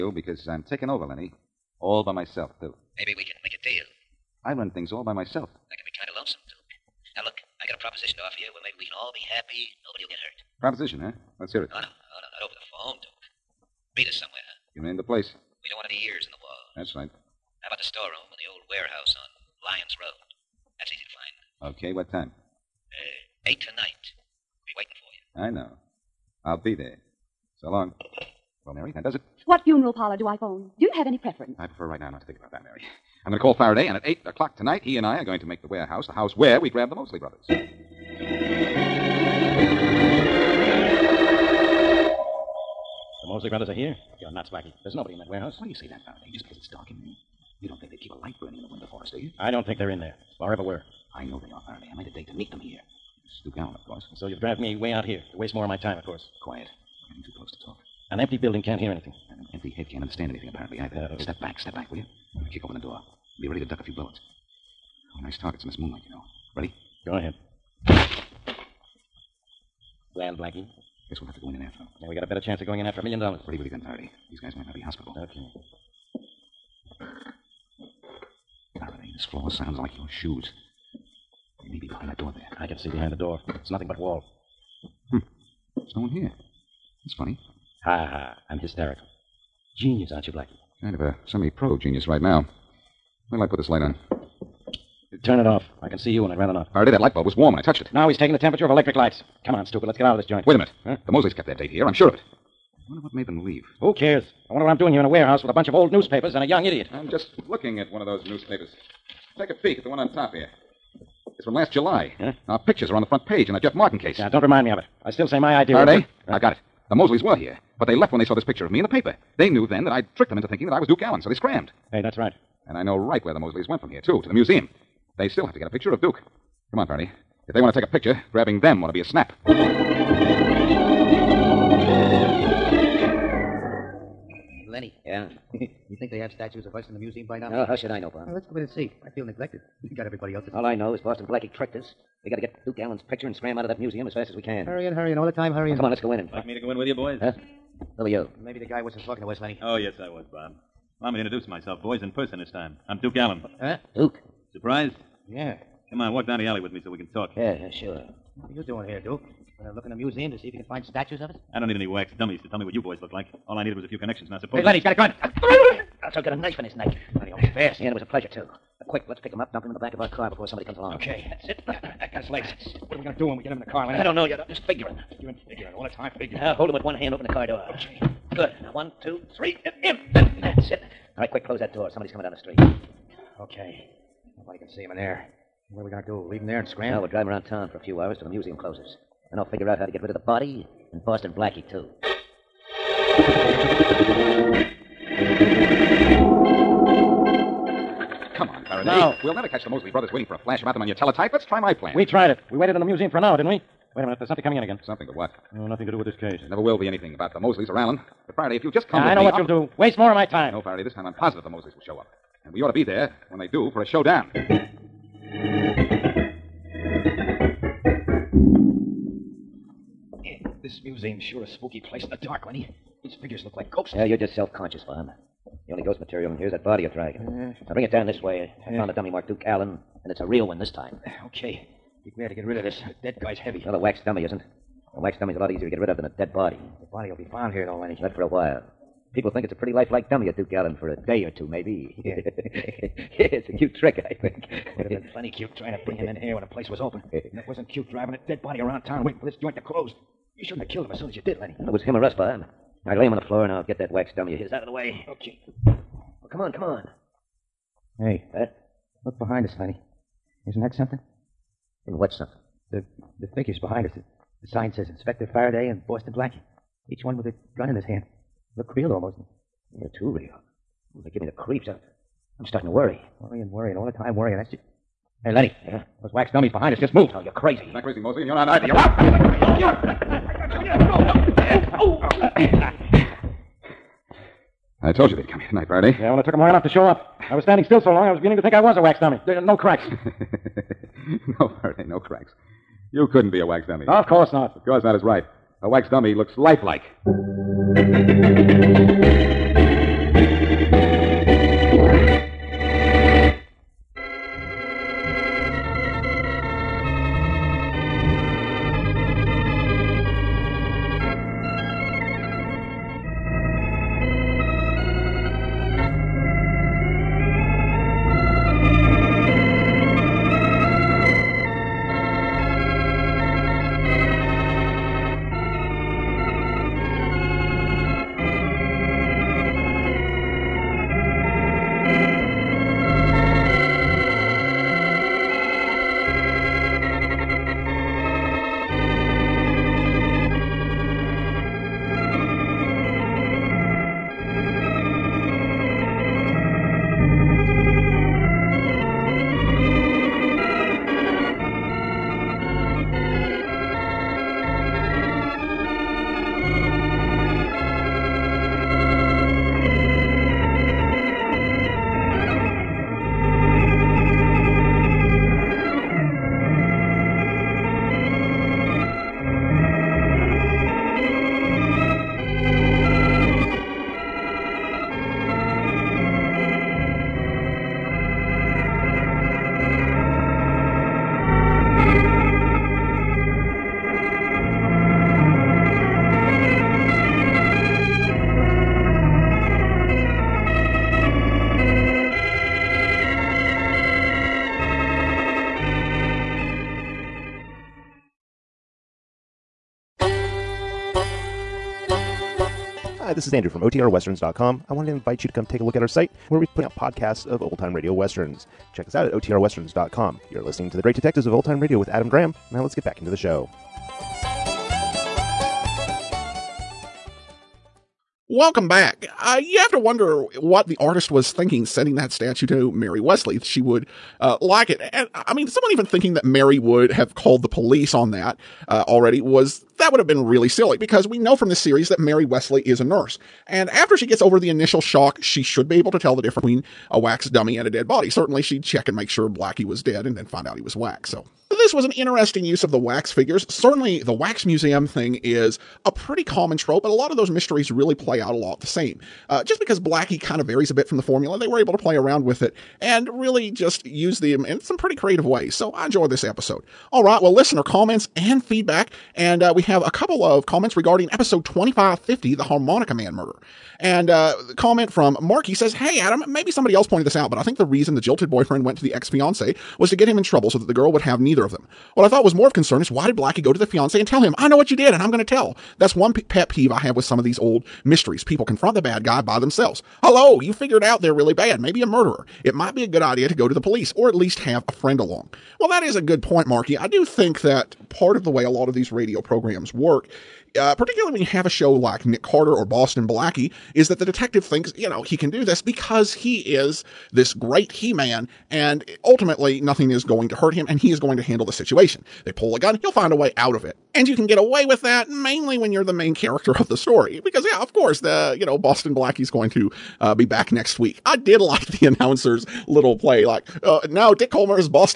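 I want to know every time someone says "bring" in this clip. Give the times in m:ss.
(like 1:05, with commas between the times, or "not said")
3:47, 4:05.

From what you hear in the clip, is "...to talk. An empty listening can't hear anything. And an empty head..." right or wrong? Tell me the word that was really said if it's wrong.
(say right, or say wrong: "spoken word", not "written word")
wrong: "building", not "listening".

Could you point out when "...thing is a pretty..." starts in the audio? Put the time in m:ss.
7:24.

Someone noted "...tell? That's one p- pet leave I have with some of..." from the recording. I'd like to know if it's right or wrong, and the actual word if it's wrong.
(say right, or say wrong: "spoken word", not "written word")
wrong: "peeve", not "leave".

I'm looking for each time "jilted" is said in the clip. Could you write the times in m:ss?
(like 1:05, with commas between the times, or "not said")
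7:48.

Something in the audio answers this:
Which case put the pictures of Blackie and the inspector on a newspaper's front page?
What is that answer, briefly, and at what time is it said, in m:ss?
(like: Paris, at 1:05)
Jeff Martin case, at 1:53.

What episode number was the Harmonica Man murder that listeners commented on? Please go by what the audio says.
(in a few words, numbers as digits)
2550.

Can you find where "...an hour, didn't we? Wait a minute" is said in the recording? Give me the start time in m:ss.
3:23.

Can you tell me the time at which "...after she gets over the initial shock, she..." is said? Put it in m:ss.
7:13.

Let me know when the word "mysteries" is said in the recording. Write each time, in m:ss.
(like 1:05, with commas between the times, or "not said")
7:27, 7:57.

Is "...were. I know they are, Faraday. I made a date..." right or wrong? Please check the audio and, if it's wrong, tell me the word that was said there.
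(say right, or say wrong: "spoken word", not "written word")
right.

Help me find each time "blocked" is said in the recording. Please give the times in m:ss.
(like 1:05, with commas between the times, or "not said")
not said.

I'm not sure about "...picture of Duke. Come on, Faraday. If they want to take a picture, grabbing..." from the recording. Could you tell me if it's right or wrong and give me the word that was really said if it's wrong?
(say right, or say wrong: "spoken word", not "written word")
right.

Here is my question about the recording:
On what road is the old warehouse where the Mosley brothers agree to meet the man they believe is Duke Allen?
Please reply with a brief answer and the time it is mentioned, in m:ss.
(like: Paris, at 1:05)
Lyons Road, at 0:19.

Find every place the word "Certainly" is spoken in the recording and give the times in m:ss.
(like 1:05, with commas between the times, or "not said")
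7:18, 7:23.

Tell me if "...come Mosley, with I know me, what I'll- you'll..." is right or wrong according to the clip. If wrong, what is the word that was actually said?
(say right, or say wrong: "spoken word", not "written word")
wrong: "Now", not "Mosley".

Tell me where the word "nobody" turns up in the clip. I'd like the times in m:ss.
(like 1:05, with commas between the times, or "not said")
0:09, 0:44, 3:04.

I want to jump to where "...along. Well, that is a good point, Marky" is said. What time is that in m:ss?
8:04.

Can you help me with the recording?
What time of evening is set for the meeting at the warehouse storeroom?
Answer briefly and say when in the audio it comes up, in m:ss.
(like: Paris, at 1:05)
8, at 0:23.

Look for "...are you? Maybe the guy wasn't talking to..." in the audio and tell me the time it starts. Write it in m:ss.
2:28.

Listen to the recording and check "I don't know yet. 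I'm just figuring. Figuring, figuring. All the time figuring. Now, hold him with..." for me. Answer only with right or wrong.
right.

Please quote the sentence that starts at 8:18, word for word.
And ultimately, nothing is going to hurt him, and he is going to handle the situation.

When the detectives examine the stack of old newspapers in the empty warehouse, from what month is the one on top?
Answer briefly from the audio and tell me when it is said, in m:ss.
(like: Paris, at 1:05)
July, at 1:51.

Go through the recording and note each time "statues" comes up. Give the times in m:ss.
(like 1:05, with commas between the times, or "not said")
2:16, 2:40, 7:02.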